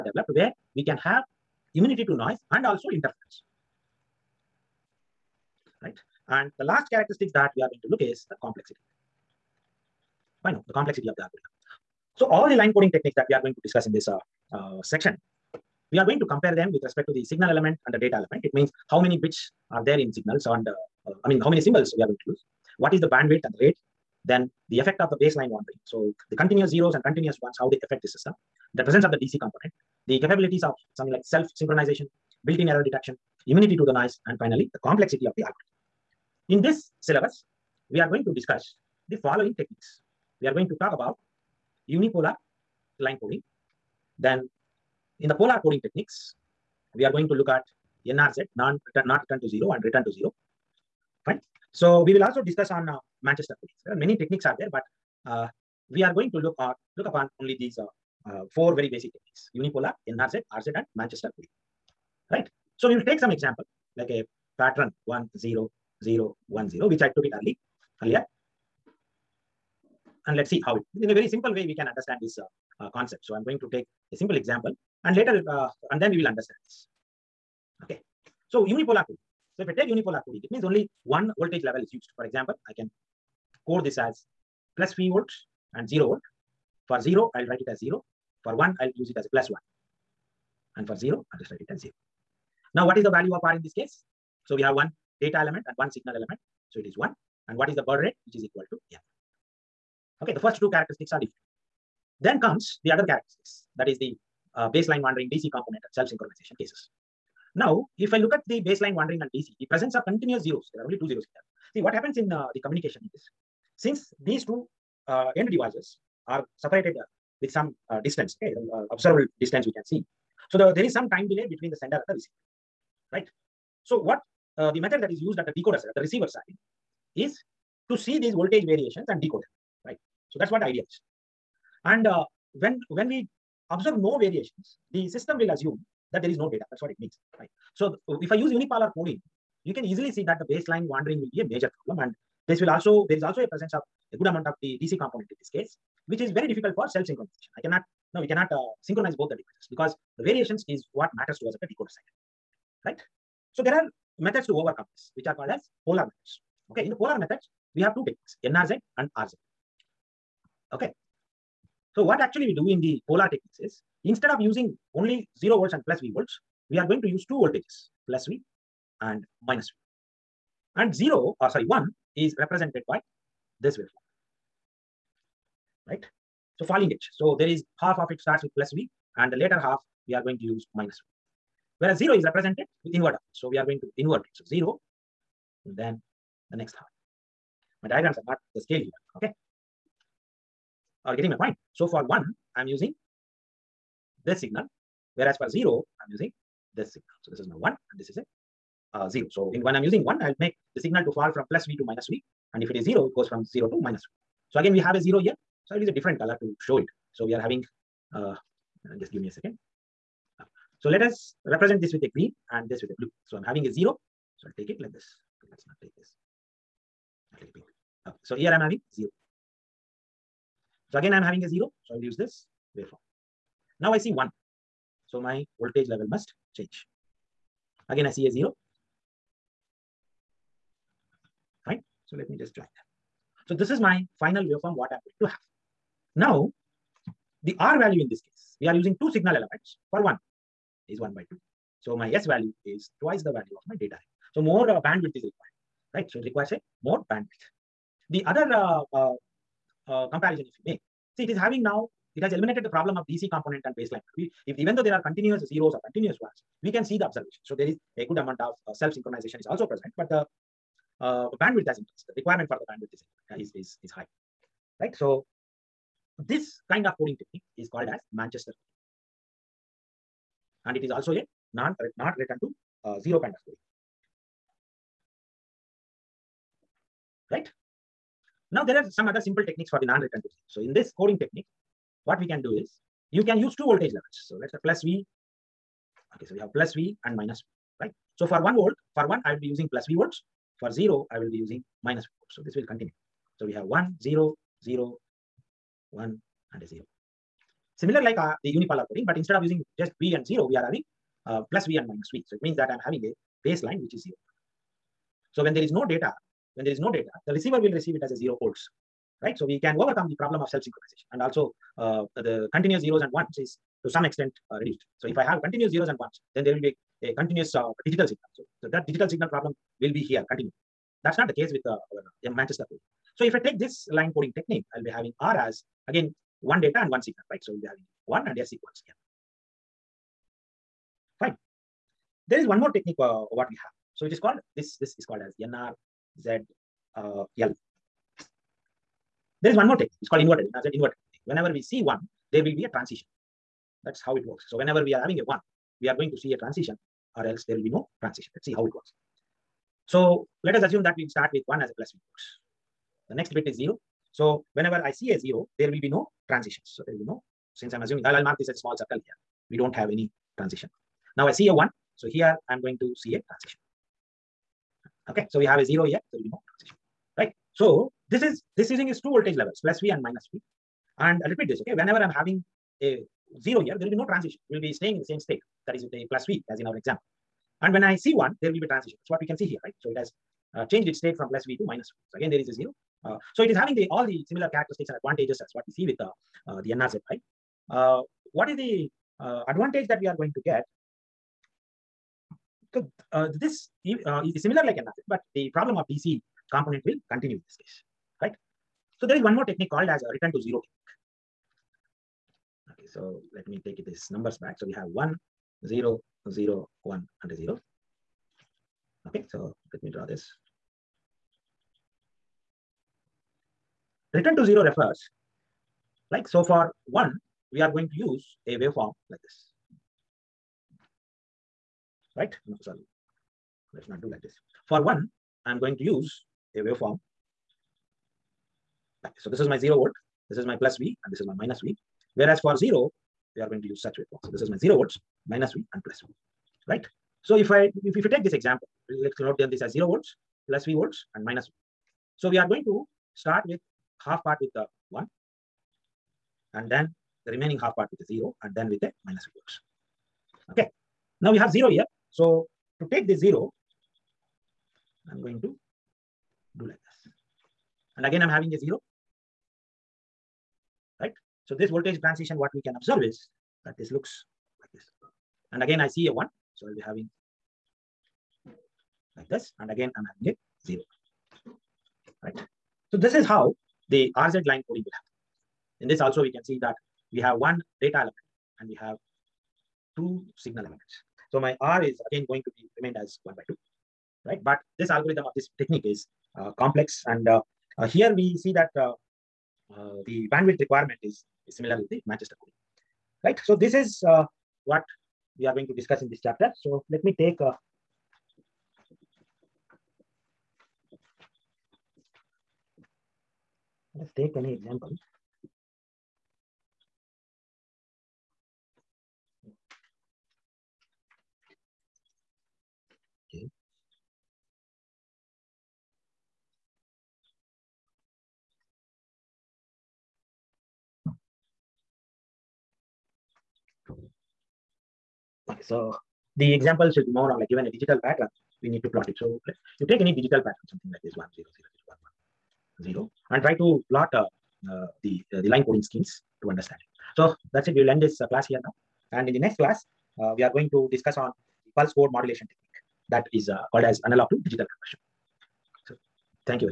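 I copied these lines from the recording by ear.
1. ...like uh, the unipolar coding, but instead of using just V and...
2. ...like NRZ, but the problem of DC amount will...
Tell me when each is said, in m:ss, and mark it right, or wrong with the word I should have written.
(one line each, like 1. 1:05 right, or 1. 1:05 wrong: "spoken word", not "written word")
1. 4:58 right
2. 6:34 wrong: "component", not "amount".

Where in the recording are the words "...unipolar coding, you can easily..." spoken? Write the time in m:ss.
2:18.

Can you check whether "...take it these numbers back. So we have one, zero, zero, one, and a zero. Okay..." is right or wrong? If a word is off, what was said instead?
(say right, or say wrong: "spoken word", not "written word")
right.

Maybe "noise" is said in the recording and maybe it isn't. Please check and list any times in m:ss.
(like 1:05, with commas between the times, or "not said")
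0:02, 0:33.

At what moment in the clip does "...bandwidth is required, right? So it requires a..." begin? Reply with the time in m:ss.
4:04.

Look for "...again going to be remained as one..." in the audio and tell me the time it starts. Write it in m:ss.
8:02.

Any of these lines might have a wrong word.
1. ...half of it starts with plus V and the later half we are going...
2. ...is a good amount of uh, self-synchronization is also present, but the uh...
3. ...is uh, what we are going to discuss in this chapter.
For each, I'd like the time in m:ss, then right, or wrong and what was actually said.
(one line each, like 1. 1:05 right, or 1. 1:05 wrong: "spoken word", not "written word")
1. 2:57 right
2. 4:17 right
3. 8:13 right.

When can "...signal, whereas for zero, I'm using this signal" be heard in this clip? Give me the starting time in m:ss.
3:14.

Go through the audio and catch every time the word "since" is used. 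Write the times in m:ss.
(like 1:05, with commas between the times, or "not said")
1:53, 5:57.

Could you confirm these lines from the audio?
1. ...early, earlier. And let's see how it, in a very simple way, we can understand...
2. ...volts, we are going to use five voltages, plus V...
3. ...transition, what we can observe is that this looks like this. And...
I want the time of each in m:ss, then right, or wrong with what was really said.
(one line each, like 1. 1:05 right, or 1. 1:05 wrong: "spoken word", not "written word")
1. 1:07 right
2. 2:46 wrong: "two", not "five"
3. 7:42 right.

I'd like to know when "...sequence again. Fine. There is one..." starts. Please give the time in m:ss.
5:28.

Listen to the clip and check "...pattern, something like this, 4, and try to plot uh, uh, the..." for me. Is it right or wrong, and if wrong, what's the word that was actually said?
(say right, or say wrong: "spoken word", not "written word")
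wrong: "0", not "4".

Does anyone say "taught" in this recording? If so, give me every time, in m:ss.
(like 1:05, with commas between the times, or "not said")
not said.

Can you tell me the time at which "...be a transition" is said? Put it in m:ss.
5:42.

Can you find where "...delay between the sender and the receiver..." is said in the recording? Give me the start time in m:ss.
2:01.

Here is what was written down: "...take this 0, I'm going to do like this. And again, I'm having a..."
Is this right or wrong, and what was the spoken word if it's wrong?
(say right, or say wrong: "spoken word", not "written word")
right.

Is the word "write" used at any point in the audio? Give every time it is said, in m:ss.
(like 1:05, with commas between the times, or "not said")
1:27, 1:31.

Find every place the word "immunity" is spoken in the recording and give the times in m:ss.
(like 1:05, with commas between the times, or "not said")
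0:01, 0:33.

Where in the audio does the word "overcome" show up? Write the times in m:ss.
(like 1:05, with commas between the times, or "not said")
2:34, 5:09.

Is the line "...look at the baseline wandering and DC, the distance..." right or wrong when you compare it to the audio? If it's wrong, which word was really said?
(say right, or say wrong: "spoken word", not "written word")
wrong: "presence", not "distance".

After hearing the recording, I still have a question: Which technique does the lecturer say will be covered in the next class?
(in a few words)
Pulse code modulation.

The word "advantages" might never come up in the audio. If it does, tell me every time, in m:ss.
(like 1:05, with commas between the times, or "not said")
6:24, 6:29.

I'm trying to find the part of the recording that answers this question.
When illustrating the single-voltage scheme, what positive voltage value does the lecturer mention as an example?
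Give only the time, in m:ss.
1:24.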